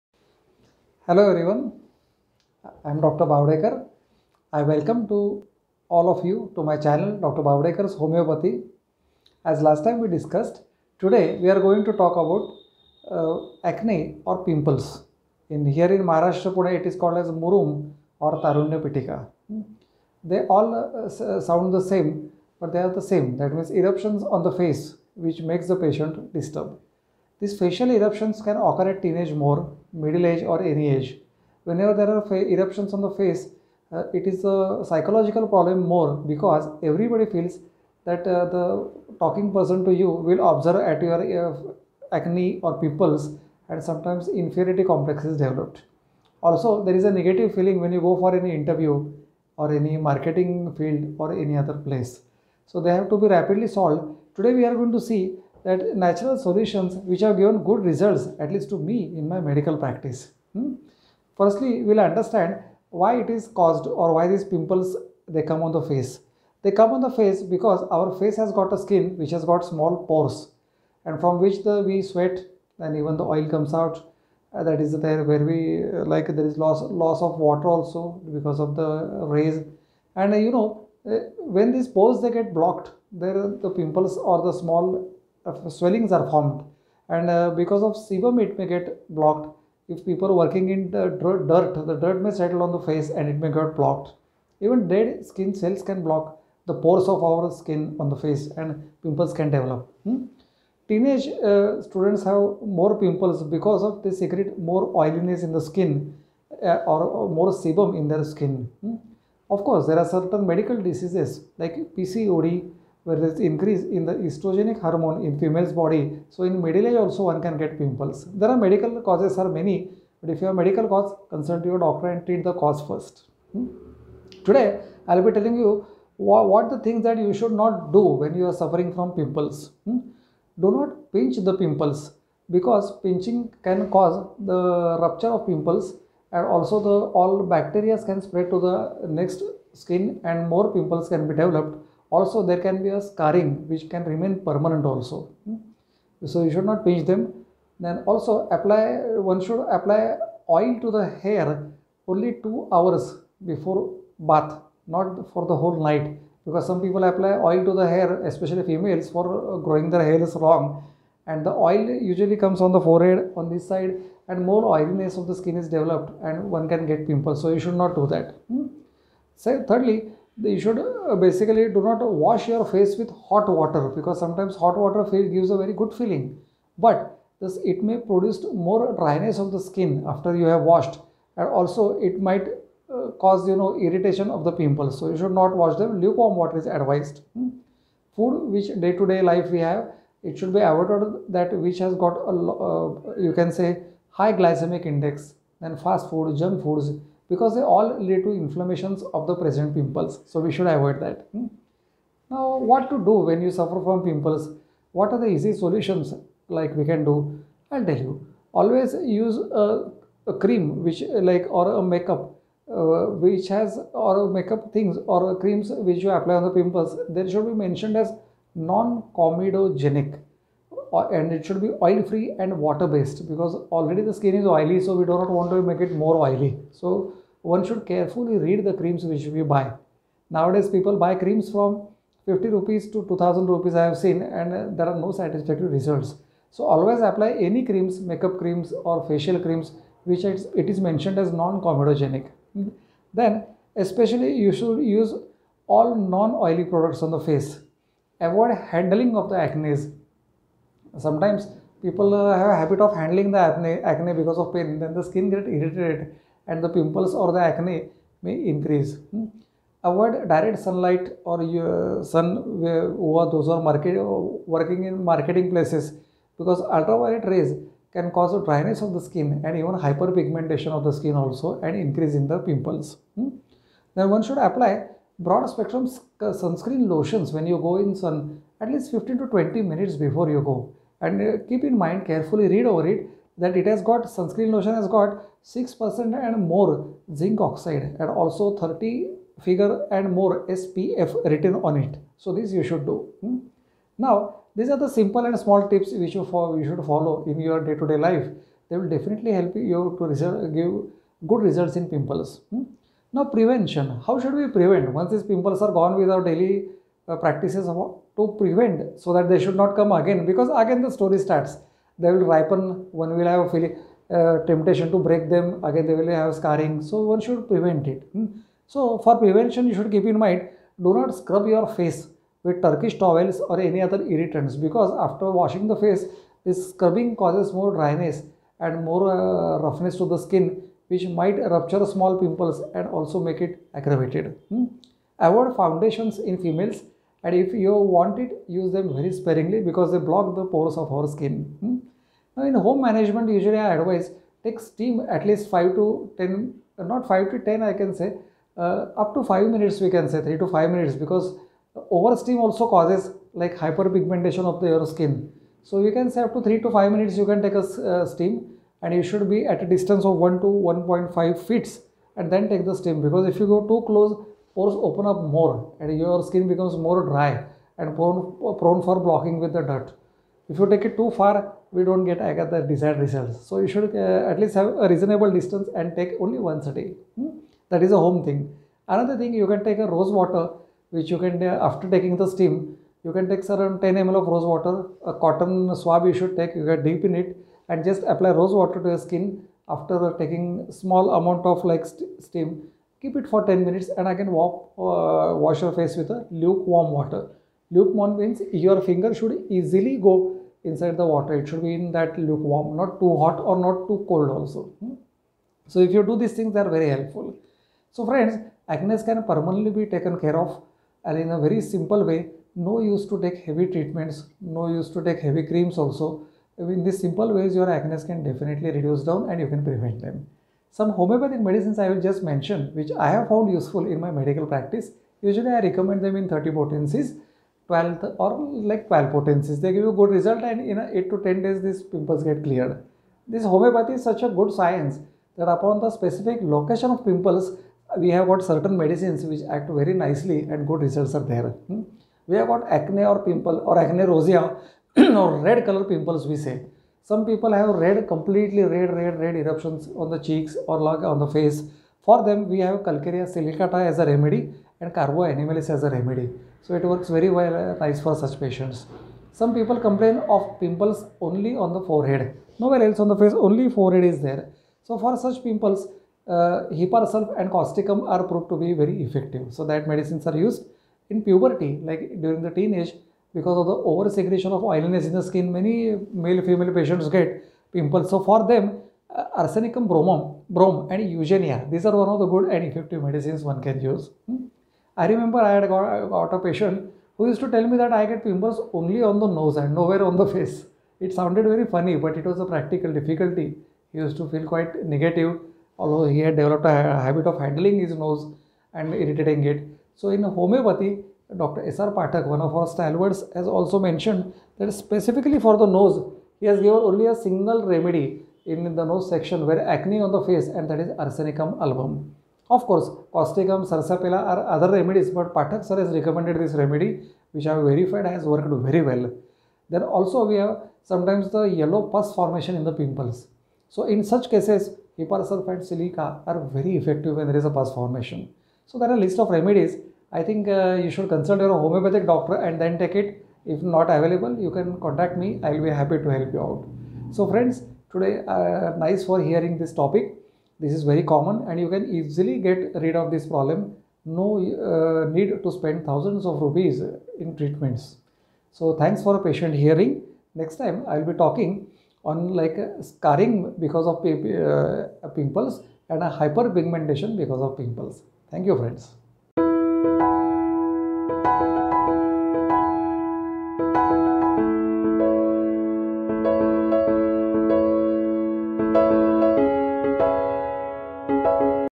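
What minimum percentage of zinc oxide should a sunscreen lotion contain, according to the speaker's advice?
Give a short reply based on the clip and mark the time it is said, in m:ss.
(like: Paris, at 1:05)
6%, at 4:45.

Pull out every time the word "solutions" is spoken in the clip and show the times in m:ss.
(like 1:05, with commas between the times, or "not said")
0:56, 3:25.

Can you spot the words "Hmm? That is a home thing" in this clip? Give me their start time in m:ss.
6:17.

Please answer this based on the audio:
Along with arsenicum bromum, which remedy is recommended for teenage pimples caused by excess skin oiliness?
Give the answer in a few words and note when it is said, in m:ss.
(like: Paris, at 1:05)
eugenia, at 8:01.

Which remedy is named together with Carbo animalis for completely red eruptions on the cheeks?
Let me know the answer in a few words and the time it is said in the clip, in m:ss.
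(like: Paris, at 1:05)
Calcarea silicata, at 7:32.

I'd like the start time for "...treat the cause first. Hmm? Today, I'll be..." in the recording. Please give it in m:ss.
2:02.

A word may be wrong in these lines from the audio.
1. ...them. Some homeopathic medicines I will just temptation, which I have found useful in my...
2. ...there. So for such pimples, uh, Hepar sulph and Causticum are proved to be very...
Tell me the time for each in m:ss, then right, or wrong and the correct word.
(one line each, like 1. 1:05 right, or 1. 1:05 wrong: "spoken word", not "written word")
1. 7:00 wrong: "mention", not "temptation"
2. 7:44 right.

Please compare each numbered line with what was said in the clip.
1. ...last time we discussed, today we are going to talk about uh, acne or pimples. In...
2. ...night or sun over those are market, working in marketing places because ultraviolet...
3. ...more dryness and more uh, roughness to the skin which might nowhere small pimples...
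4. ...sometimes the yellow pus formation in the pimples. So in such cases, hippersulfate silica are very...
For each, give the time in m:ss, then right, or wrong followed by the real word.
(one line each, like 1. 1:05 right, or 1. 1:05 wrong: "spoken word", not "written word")
1. 0:09 right
2. 4:20 wrong: "sunlight", not "night"
3. 5:27 wrong: "rupture", not "nowhere"
4. 8:40 right.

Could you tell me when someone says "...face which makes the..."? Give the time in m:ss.
0:24.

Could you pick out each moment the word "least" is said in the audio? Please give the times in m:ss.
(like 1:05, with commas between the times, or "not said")
0:58, 4:38, 5:45, 6:14.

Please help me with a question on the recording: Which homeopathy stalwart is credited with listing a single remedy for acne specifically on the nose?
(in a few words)
Dr. S.R. Phatak.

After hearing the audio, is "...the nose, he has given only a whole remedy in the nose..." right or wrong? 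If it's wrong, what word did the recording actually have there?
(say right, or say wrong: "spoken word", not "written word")
wrong: "single", not "whole".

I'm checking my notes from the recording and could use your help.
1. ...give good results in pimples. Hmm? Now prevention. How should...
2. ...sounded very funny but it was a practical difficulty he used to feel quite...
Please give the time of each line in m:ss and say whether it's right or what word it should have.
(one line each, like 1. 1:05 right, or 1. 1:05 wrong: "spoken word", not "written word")
1. 5:00 right
2. 8:11 right.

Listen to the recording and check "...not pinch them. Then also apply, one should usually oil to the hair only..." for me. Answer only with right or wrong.
wrong.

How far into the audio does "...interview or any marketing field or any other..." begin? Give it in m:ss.
0:48.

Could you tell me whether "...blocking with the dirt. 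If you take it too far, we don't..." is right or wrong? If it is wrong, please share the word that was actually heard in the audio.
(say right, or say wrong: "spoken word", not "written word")
right.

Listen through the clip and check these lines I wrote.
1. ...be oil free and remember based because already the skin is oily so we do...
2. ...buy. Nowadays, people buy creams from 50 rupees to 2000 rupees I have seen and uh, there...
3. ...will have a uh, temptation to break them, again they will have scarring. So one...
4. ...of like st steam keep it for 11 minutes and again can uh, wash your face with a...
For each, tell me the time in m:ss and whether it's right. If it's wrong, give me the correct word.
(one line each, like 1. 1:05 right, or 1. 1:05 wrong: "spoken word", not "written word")
1. 3:41 wrong: "water", not "remember"
2. 3:49 right
3. 5:13 right
4. 6:31 wrong: "10", not "11".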